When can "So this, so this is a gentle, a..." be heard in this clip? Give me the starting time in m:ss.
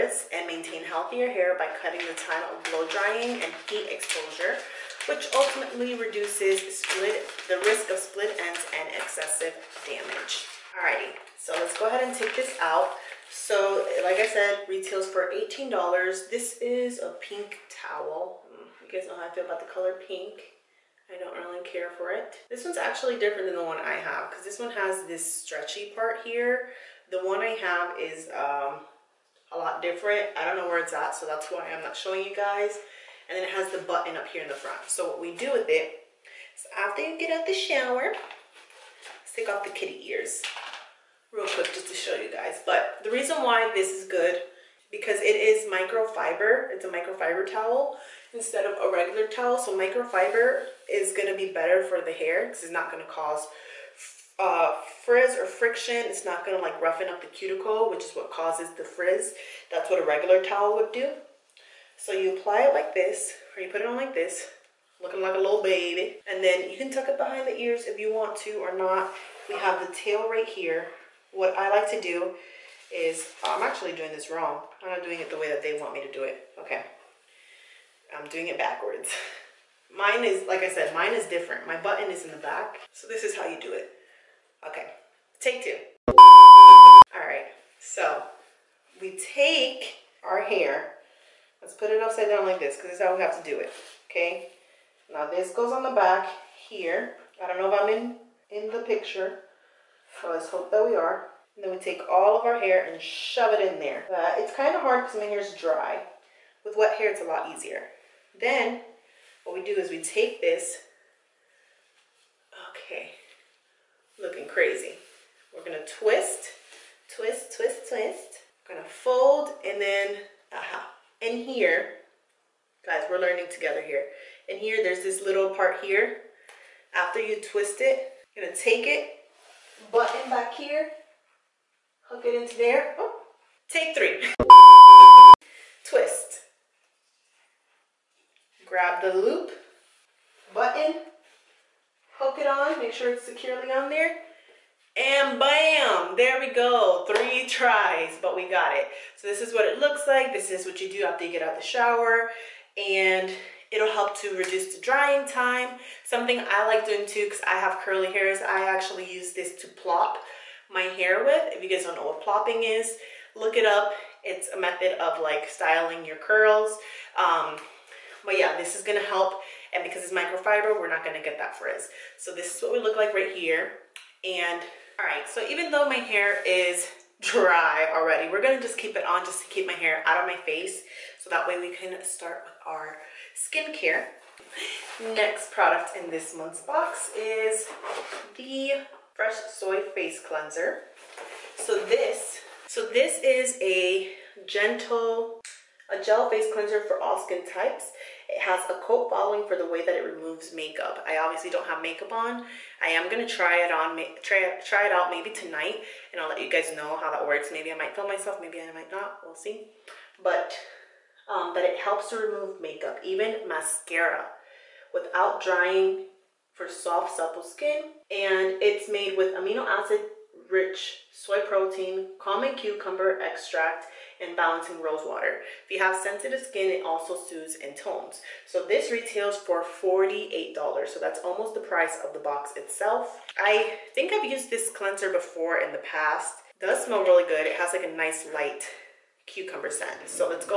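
3:11.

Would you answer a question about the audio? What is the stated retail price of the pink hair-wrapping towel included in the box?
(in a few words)
$18.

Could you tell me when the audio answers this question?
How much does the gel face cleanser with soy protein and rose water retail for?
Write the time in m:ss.
3:49.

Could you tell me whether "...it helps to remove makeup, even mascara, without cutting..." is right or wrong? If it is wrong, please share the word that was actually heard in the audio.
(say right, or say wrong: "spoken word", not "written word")
wrong: "drying", not "cutting".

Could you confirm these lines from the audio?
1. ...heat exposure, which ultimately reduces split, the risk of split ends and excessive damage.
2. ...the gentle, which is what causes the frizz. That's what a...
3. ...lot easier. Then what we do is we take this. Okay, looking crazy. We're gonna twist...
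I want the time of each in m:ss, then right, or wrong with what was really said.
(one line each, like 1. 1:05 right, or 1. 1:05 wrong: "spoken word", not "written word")
1. 0:03 right
2. 0:57 wrong: "cuticle", not "gentle"
3. 1:47 right.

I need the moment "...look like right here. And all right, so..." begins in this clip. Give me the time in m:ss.
2:52.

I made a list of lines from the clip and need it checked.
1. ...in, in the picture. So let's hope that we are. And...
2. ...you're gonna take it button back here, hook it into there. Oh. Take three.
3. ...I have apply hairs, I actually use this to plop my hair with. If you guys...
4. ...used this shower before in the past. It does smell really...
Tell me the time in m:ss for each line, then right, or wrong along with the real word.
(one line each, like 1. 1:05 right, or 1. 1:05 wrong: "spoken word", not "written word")
1. 1:37 right
2. 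2:08 right
3. 2:37 wrong: "curly", not "apply"
4. 3:54 wrong: "cleanser", not "shower".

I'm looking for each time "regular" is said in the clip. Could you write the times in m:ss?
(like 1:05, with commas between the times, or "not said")
0:48, 1:00.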